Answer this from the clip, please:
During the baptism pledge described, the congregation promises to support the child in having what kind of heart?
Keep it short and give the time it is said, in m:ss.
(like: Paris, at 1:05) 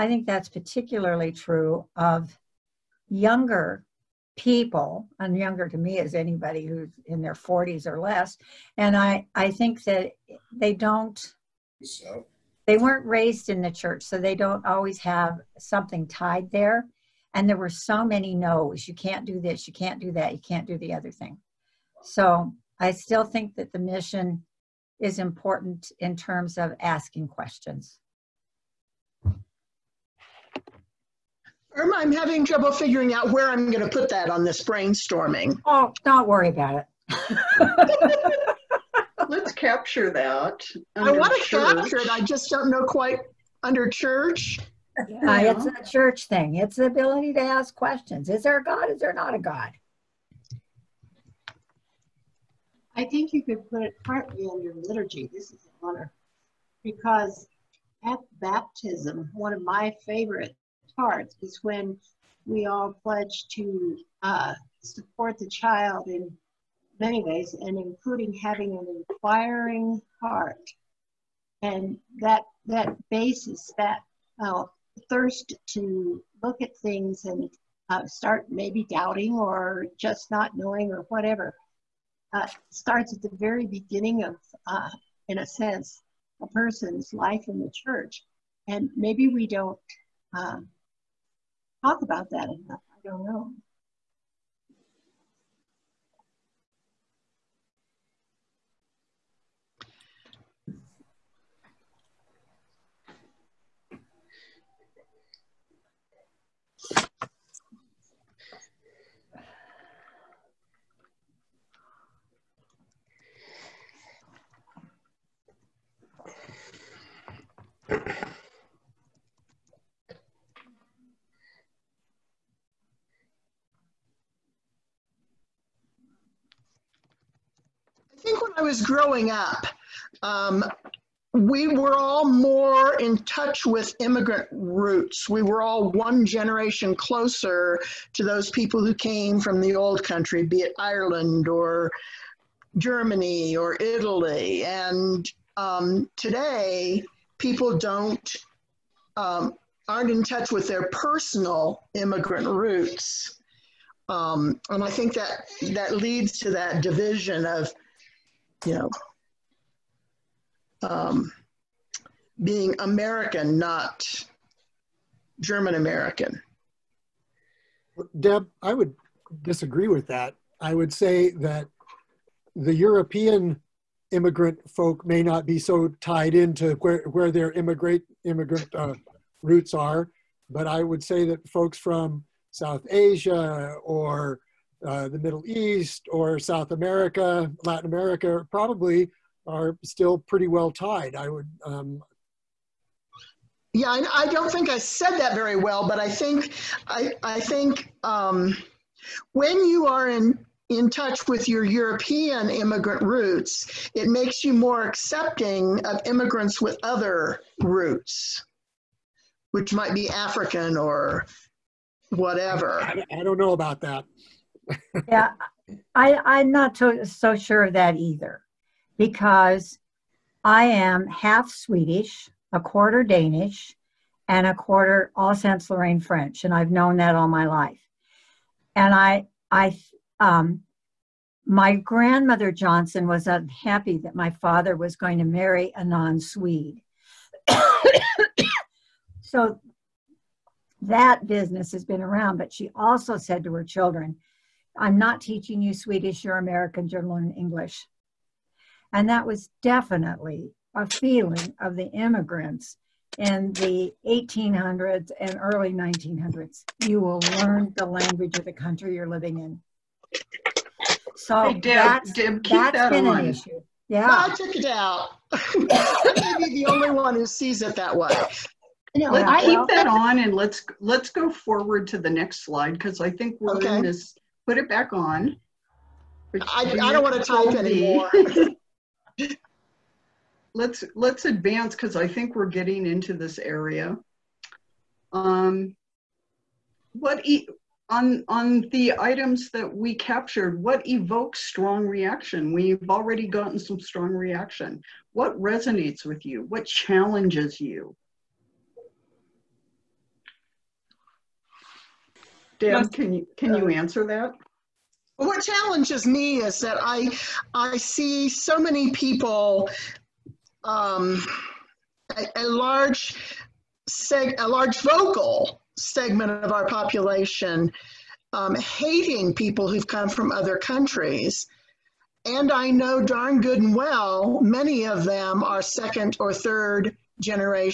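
An inquiring heart, at 1:09.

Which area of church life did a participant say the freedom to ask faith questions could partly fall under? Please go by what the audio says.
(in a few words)
Liturgy.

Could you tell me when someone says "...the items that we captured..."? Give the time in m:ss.
4:48.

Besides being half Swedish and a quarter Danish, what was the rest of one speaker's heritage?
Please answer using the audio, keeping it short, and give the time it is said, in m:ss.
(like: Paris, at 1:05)
Alsace Lorraine French, at 3:45.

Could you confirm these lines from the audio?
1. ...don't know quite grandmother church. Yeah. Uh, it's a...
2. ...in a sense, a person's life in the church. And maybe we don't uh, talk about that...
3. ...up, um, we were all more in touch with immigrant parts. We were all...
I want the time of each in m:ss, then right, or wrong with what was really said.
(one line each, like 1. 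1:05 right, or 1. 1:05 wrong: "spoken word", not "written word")
1. 0:42 wrong: "under", not "grandmother"
2. 1:25 right
3. 2:09 wrong: "roots", not "parts".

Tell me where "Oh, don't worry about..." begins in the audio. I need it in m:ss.
0:35.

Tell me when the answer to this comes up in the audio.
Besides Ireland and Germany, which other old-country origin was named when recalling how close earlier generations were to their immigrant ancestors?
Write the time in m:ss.
2:23.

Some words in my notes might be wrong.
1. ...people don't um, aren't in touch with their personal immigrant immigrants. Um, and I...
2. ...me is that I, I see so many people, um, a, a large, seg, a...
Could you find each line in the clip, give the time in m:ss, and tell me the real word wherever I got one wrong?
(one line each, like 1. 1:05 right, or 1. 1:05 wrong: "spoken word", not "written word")
1. 2:27 wrong: "roots", not "immigrants"
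2. 5:06 right.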